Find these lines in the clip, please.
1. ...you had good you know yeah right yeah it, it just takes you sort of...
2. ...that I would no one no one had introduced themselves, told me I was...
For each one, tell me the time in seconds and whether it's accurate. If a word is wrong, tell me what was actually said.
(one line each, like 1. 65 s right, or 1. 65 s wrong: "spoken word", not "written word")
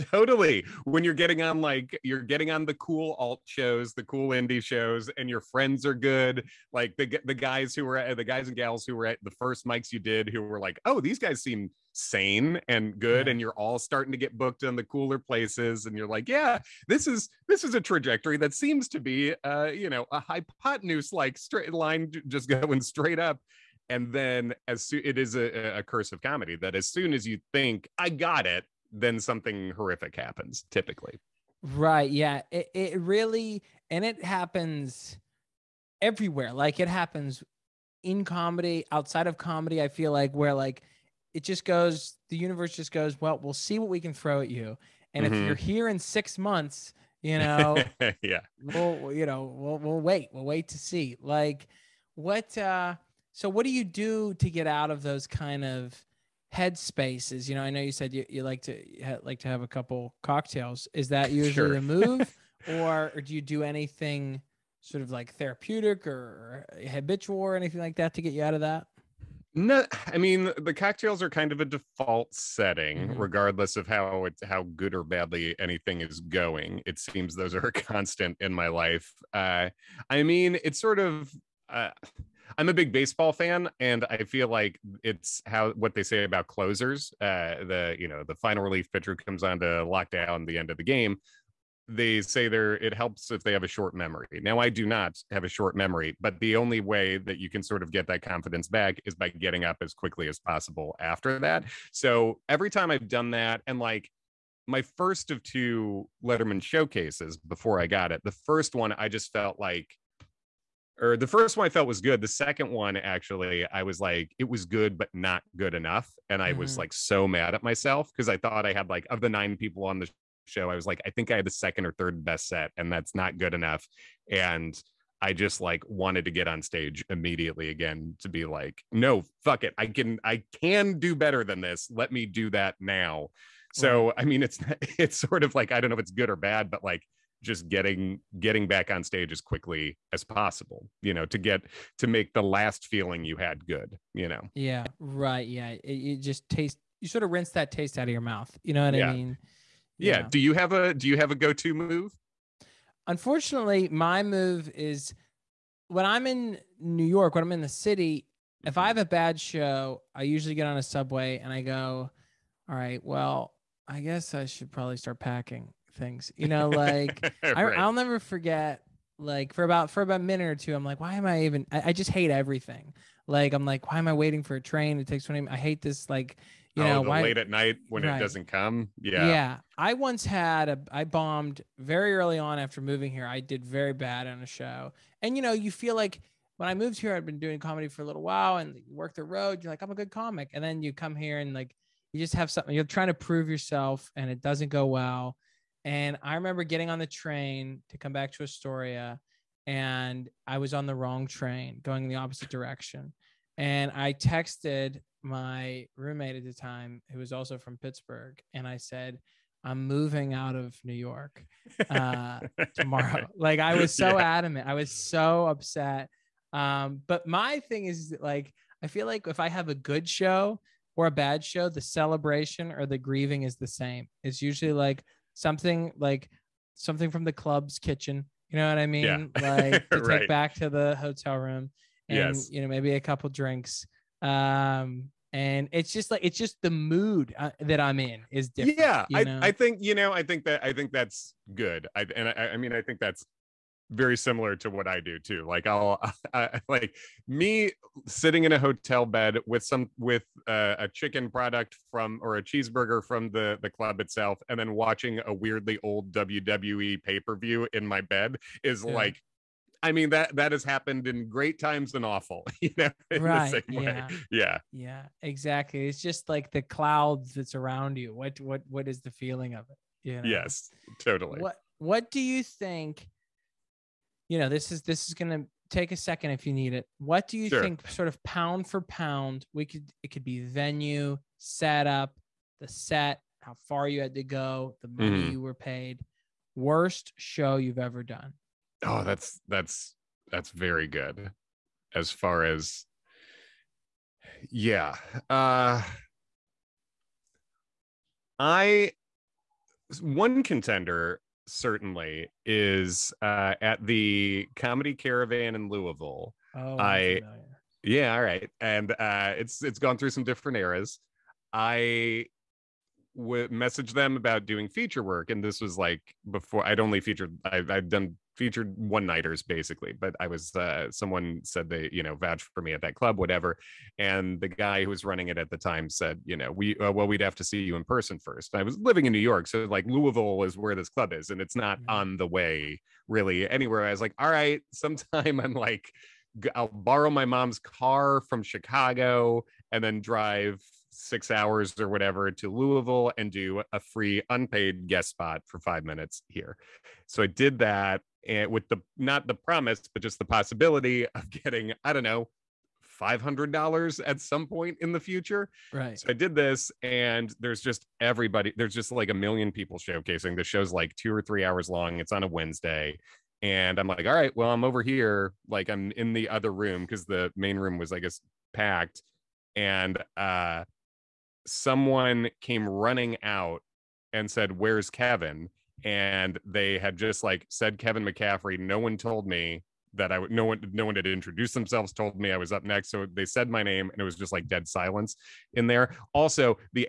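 1. 143 s wrong: "tastes", not "takes"
2. 379 s right.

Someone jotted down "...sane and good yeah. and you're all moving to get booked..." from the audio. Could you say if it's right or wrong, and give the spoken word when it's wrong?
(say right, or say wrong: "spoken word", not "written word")
wrong: "starting", not "moving".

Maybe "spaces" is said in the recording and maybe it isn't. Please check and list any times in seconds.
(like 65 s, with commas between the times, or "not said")
56 s.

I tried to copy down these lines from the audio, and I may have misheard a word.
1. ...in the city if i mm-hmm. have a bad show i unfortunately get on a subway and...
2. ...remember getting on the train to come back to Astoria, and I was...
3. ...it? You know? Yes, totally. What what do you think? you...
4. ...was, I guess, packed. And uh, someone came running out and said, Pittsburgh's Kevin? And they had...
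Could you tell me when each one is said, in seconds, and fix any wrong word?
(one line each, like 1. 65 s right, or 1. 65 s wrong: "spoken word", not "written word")
1. 157 s wrong: "usually", not "unfortunately"
2. 196 s right
3. 269 s right
4. 367 s wrong: "Where", not "Pittsburgh".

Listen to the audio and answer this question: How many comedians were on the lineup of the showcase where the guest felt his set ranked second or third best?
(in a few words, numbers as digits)
9.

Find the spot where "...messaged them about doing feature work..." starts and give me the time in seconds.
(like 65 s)
313 s.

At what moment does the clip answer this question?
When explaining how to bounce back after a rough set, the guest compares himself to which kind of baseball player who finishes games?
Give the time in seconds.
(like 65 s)
86 s.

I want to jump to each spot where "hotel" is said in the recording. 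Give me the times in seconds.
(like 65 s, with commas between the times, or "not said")
230 s, 248 s.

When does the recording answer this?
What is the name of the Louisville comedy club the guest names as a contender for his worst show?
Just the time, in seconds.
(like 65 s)
304 s.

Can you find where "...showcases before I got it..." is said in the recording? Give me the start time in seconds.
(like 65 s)
106 s.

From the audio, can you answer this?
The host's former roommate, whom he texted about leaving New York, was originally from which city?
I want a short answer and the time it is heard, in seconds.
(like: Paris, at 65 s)
Pittsburgh, at 207 s.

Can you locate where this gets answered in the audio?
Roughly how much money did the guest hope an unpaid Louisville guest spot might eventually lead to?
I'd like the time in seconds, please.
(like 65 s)
352 s.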